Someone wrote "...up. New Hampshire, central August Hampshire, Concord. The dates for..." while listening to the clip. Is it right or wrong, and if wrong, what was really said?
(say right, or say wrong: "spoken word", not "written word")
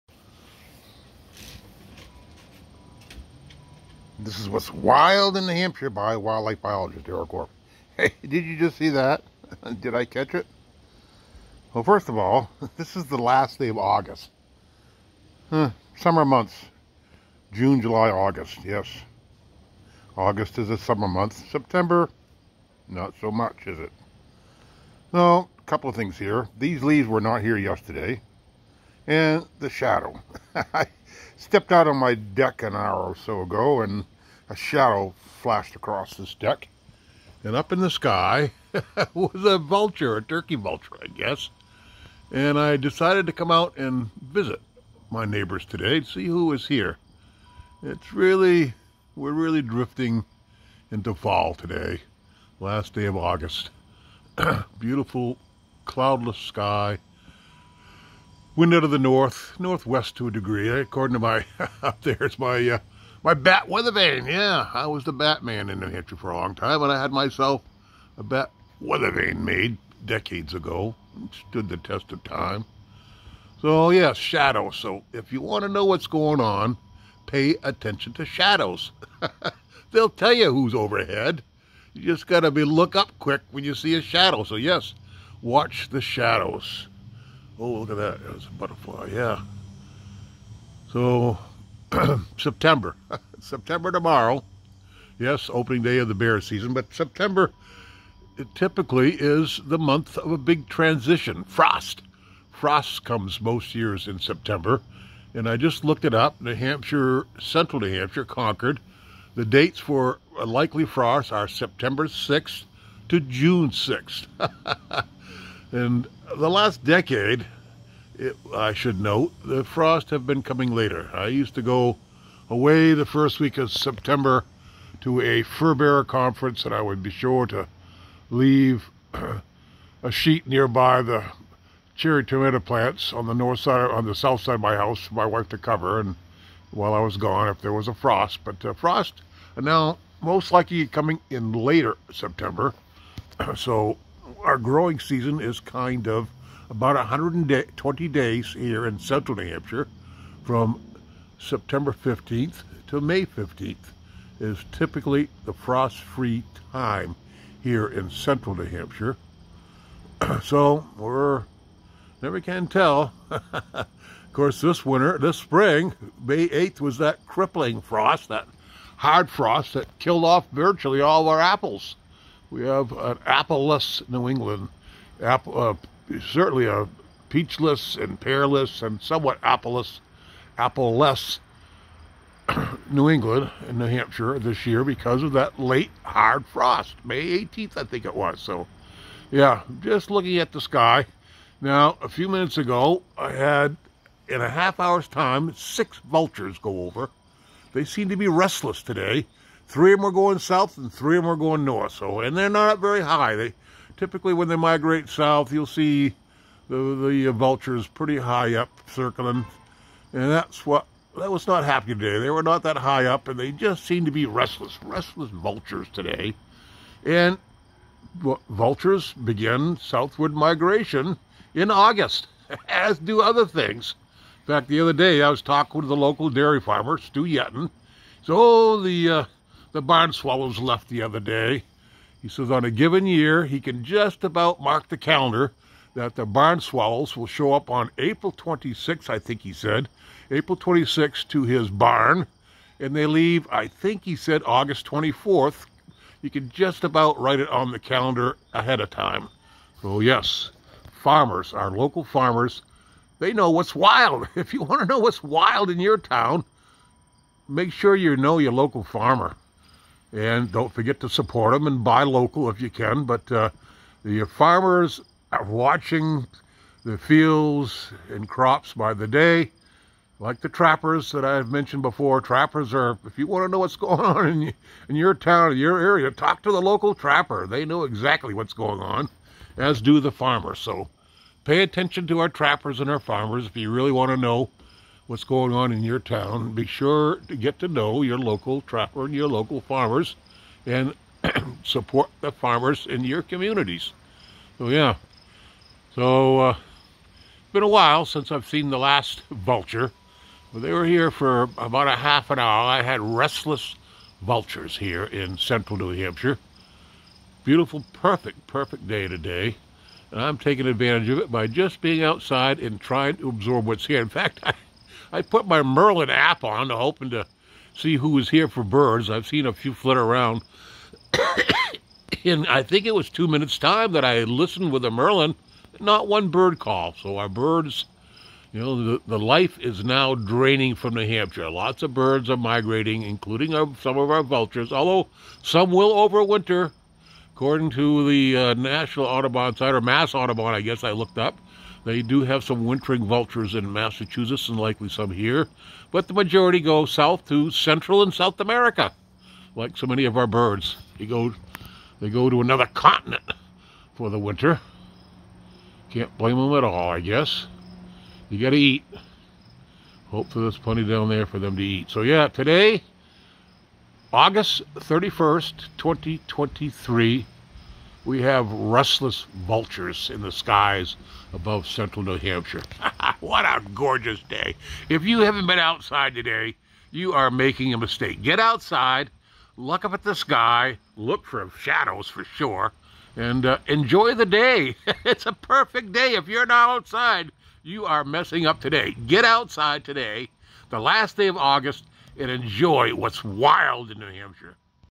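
wrong: "New", not "August".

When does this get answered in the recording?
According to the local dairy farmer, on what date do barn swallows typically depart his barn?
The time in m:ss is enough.
4:04.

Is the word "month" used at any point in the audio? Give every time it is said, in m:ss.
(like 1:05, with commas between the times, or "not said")
0:16, 0:21, 1:39.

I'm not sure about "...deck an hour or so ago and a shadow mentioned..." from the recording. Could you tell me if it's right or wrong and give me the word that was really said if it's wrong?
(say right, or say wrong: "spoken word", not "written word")
wrong: "flashed", not "mentioned".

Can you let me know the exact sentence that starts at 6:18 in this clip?
Get outside, look up at the sky, look for shadows for sure, and uh, enjoy the day.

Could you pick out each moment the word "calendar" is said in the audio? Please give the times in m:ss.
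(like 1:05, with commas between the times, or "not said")
3:54, 4:07.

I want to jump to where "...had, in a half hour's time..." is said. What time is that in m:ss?
3:13.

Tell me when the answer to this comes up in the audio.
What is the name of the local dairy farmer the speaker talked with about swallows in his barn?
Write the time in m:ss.
3:46.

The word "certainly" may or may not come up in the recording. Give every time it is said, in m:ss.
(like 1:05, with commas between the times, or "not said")
2:56.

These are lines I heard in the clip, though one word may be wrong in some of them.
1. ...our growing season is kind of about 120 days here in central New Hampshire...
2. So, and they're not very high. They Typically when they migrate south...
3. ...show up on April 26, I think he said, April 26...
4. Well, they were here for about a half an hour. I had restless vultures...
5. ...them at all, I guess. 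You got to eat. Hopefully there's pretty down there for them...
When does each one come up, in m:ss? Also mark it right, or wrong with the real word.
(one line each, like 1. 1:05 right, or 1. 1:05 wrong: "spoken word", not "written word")
1. 2:24 right
2. 3:21 right
3. 3:57 right
4. 5:00 right
5. 5:56 wrong: "plenty", not "pretty".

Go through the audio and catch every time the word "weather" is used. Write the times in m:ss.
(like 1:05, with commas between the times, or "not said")
1:03, 1:08.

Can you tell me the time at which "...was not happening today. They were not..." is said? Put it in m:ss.
3:31.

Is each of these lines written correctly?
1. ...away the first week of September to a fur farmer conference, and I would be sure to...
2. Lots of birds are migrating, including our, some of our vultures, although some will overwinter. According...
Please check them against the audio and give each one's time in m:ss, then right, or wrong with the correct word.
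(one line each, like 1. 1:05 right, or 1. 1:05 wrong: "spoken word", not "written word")
1. 2:02 wrong: "bearer", not "farmer"
2. 5:31 right.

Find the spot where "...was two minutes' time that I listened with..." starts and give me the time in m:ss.
5:22.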